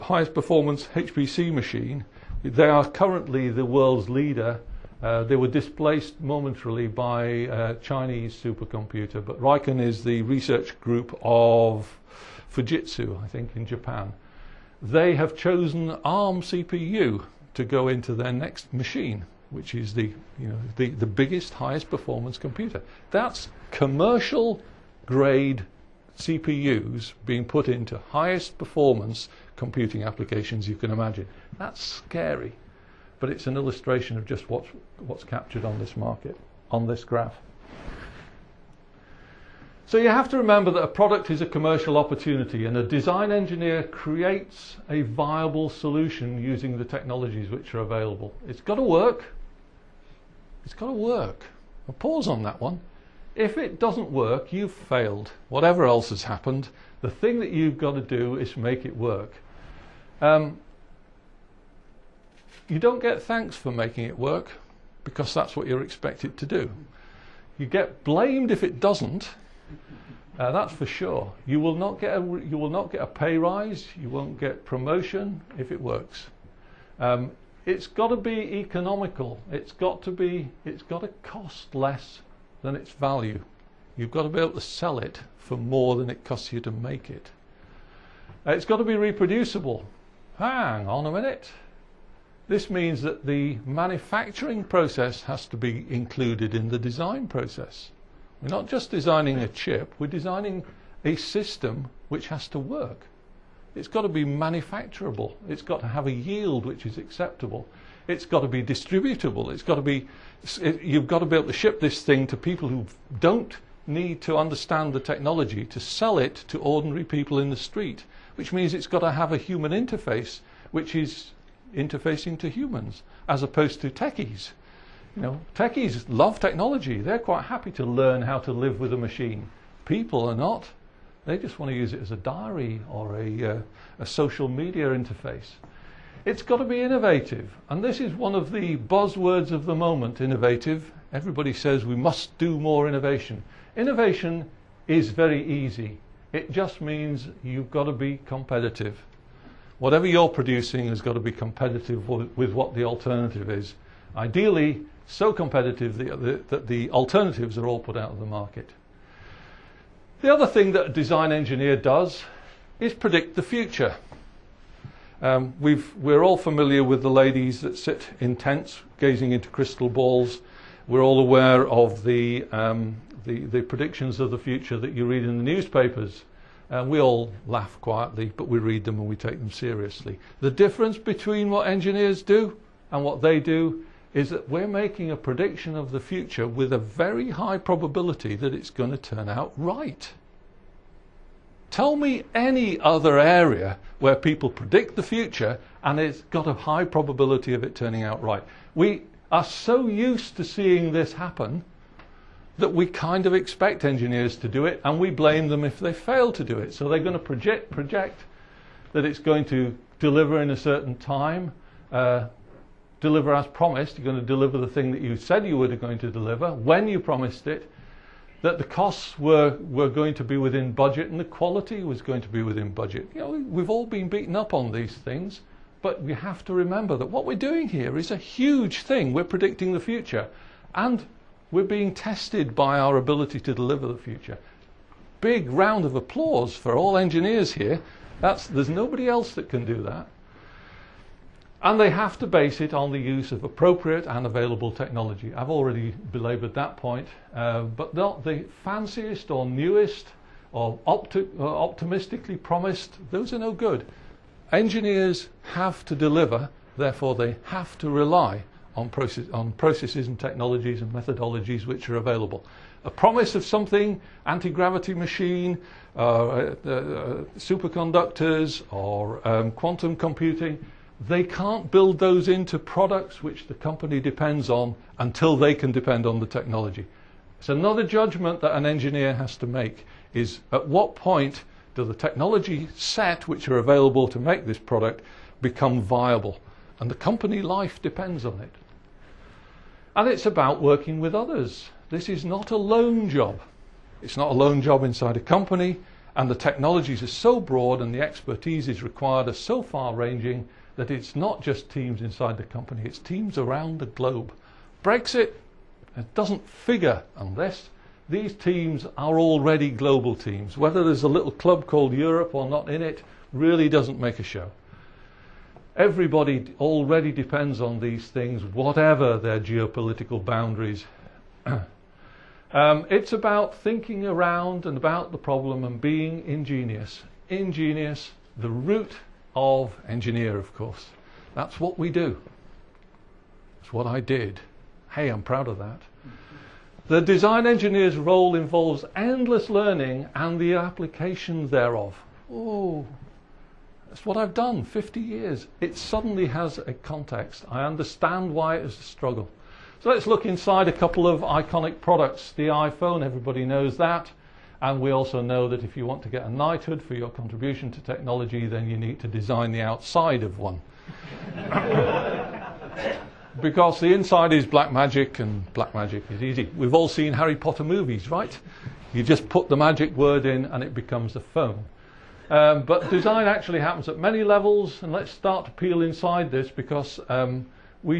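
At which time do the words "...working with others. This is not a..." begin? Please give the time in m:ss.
4:50.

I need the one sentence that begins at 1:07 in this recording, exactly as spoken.
You get blamed if it doesn't.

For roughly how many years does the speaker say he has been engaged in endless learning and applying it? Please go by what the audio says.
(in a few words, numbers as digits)
50 years.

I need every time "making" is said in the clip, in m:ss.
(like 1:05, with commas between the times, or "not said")
1:03, 3:04.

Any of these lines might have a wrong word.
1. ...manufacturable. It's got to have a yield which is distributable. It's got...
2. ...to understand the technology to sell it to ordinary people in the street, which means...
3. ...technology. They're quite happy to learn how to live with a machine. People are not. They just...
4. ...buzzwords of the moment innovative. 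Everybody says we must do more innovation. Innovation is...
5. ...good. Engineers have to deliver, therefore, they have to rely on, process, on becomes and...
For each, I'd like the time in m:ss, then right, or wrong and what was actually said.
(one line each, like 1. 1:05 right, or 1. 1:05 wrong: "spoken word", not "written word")
1. 1:44 wrong: "acceptable", not "distributable"
2. 1:54 right
3. 2:06 right
4. 2:18 right
5. 4:13 wrong: "processes", not "becomes".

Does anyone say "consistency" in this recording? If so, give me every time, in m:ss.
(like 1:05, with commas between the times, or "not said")
not said.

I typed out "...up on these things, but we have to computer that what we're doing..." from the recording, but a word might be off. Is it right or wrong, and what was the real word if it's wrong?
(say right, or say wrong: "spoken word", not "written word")
wrong: "remember", not "computer".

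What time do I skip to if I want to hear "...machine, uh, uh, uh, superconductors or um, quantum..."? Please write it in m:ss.
4:24.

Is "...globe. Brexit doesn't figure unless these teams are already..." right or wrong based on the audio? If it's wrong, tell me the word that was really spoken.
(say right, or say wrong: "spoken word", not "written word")
right.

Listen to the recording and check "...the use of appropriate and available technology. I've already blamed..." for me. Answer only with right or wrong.
wrong.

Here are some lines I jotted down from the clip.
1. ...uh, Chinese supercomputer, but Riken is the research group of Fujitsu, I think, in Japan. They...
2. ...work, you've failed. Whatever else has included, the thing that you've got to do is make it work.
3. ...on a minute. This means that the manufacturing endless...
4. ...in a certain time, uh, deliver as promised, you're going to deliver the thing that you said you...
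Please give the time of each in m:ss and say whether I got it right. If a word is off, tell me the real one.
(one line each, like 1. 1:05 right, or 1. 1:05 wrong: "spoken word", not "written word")
1. 0:07 right
2. 0:54 wrong: "happened", not "included"
3. 1:30 wrong: "process", not "endless"
4. 3:30 right.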